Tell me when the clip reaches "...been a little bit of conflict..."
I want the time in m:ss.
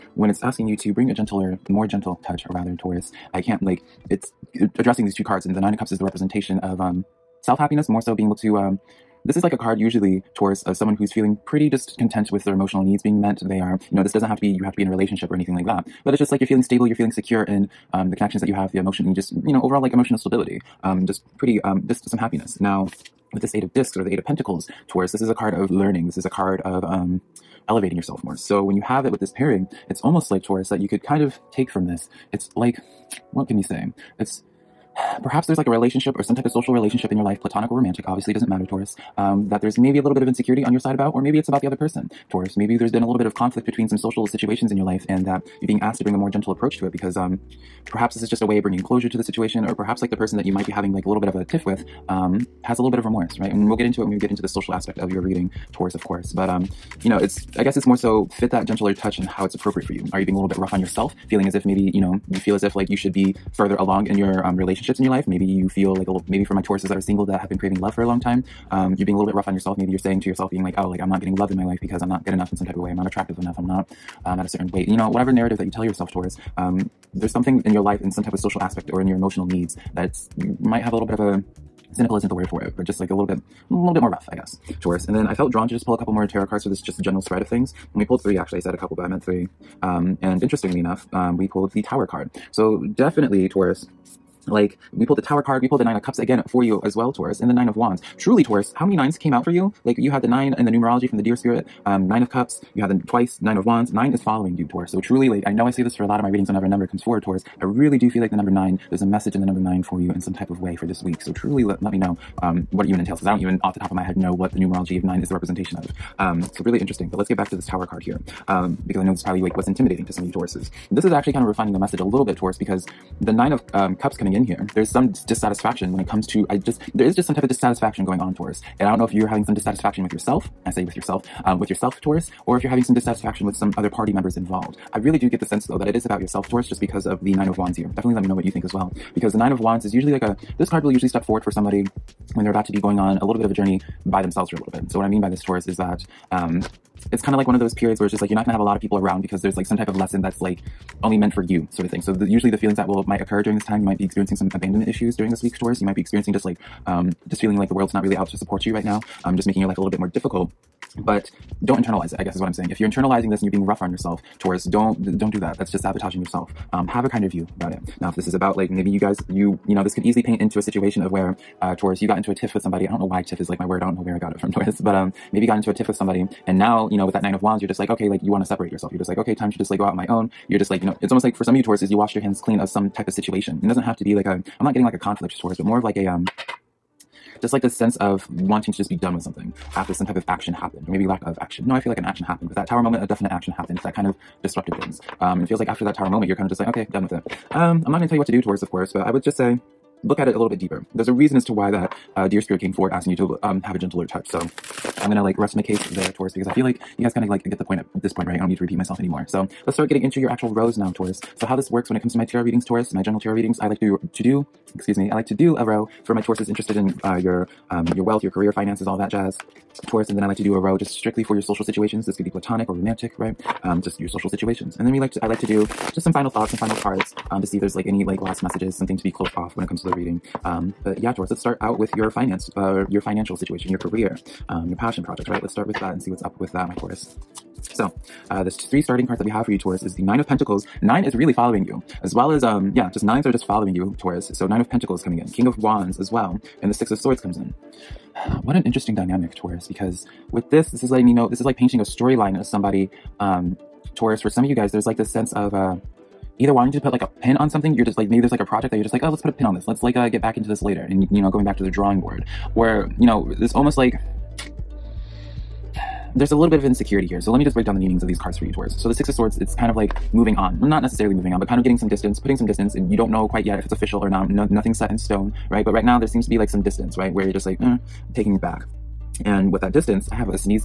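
0:42.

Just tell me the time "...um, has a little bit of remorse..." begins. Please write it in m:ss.
0:52.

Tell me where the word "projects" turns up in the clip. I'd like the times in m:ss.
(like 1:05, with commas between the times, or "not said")
3:55, 4:18.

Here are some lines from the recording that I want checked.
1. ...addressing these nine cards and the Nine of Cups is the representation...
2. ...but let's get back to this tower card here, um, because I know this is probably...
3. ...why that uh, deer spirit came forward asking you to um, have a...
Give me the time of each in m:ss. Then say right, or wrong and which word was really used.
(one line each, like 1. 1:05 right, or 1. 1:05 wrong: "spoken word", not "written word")
1. 0:04 wrong: "two", not "nine"
2. 1:57 right
3. 3:21 right.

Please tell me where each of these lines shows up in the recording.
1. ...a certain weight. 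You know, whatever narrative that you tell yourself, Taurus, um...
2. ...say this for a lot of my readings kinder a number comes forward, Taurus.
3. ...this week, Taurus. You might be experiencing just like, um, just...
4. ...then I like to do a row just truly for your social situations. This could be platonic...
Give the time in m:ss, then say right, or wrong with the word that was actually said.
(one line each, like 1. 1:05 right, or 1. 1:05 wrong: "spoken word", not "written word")
1. 1:14 right
2. 1:45 wrong: "whenever", not "kinder"
3. 2:35 right
4. 3:40 wrong: "strictly", not "truly".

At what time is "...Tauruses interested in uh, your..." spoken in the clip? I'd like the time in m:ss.
3:36.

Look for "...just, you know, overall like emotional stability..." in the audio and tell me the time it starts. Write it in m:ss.
0:19.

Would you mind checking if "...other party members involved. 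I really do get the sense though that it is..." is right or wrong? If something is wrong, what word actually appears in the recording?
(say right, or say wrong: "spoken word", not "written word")
right.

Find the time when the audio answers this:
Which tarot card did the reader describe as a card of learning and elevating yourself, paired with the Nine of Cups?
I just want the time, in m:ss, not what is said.
0:24.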